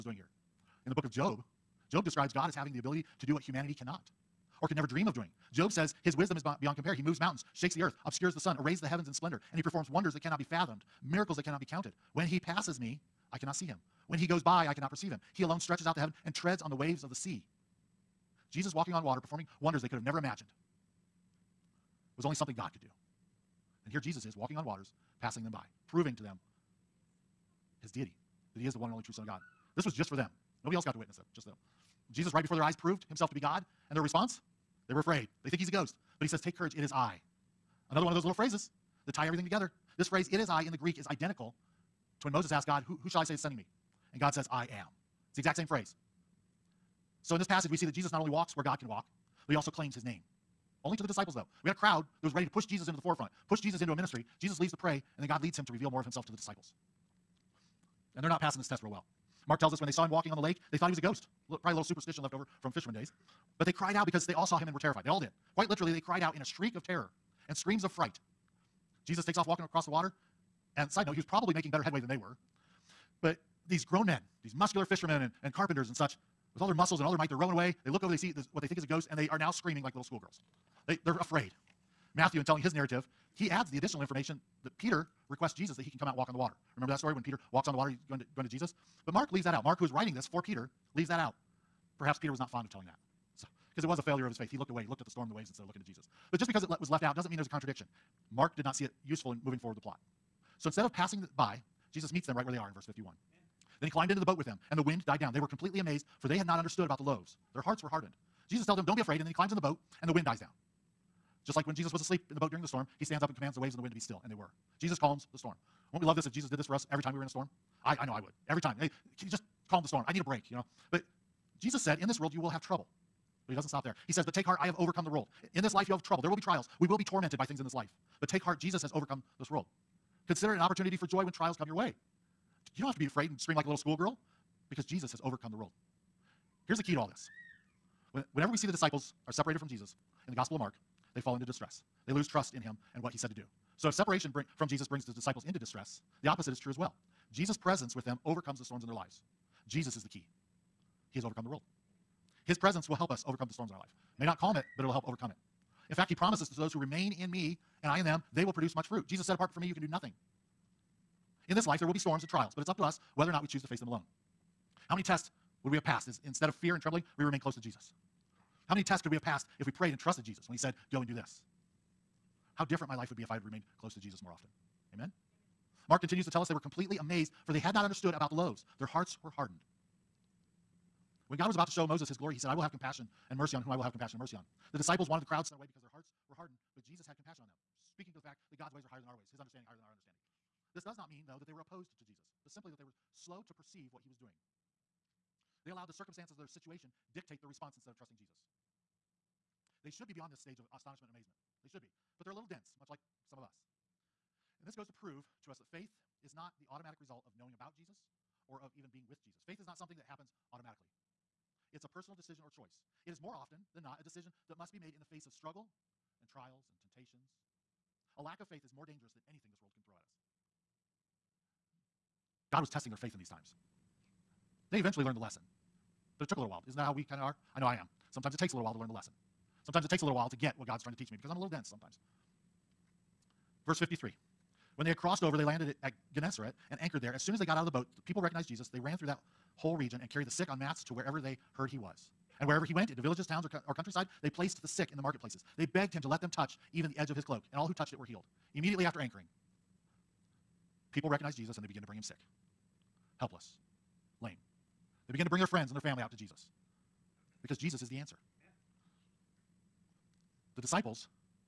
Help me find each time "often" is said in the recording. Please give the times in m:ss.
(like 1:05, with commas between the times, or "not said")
2:54, 3:33.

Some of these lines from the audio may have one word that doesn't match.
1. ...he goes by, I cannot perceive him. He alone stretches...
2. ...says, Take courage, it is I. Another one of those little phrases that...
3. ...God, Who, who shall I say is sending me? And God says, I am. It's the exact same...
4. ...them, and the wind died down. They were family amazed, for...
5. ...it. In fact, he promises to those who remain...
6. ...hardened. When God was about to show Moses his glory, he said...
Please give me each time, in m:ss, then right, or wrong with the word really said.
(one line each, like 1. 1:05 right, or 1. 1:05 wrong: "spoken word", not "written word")
1. 0:14 right
2. 0:36 right
3. 0:42 right
4. 1:44 wrong: "completely", not "family"
5. 2:35 right
6. 2:59 right.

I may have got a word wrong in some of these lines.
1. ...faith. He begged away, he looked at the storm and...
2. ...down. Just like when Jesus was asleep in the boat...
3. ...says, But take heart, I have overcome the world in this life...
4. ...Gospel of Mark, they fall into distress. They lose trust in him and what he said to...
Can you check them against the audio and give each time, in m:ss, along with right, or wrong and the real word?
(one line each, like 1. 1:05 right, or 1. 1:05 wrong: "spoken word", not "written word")
1. 1:34 wrong: "looked", not "begged"
2. 1:50 right
3. 2:04 right
4. 2:20 right.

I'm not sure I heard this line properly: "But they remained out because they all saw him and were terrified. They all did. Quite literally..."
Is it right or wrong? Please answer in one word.
wrong.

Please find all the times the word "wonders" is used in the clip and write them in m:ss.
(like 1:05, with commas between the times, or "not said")
0:09, 0:19.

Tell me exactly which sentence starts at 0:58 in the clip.
And they're not passing this test real well.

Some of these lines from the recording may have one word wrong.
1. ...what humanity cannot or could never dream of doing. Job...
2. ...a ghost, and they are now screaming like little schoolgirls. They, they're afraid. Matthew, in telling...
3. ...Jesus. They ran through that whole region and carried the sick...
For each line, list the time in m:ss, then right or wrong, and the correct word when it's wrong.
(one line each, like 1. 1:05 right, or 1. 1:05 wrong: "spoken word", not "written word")
1. 0:03 right
2. 1:18 right
3. 3:58 right.